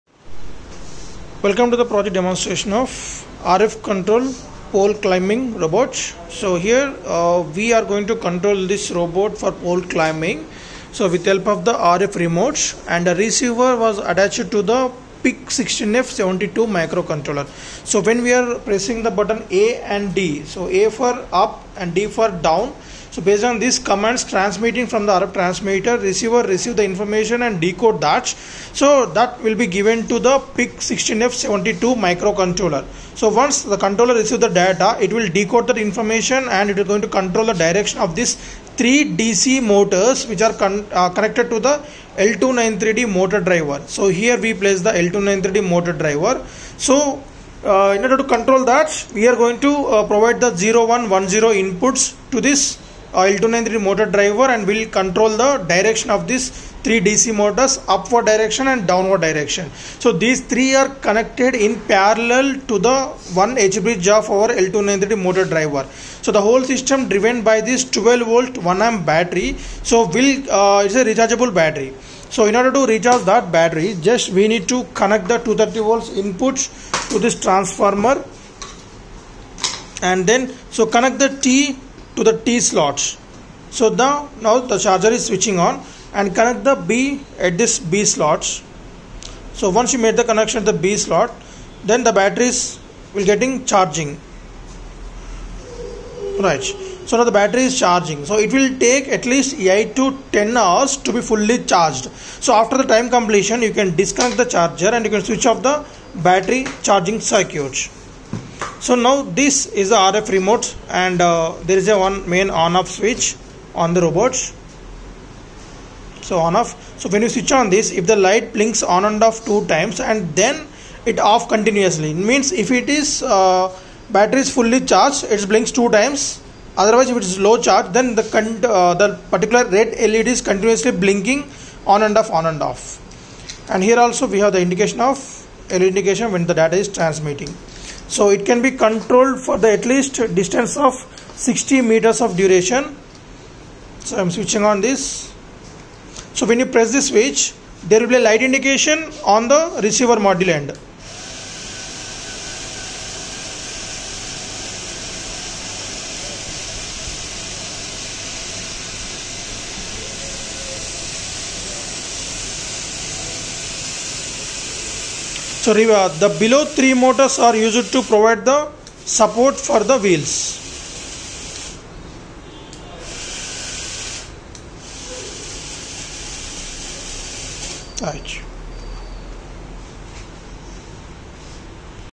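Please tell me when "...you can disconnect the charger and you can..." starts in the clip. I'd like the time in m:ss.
1:43.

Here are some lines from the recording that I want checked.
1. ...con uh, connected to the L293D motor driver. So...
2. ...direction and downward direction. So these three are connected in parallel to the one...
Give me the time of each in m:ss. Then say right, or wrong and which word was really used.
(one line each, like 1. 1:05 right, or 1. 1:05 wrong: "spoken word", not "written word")
1. 0:40 right
2. 0:58 right.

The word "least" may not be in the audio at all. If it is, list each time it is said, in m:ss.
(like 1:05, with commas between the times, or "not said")
1:39, 2:19.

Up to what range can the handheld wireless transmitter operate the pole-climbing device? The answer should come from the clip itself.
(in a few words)
60 meters.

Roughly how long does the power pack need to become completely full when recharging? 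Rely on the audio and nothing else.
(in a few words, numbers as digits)
8 to 10 hours.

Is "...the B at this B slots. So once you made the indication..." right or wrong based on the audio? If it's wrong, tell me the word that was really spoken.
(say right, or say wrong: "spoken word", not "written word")
wrong: "connection", not "indication".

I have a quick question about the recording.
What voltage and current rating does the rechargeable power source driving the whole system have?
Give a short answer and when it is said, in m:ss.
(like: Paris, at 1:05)
12 volt 1 amp, at 1:07.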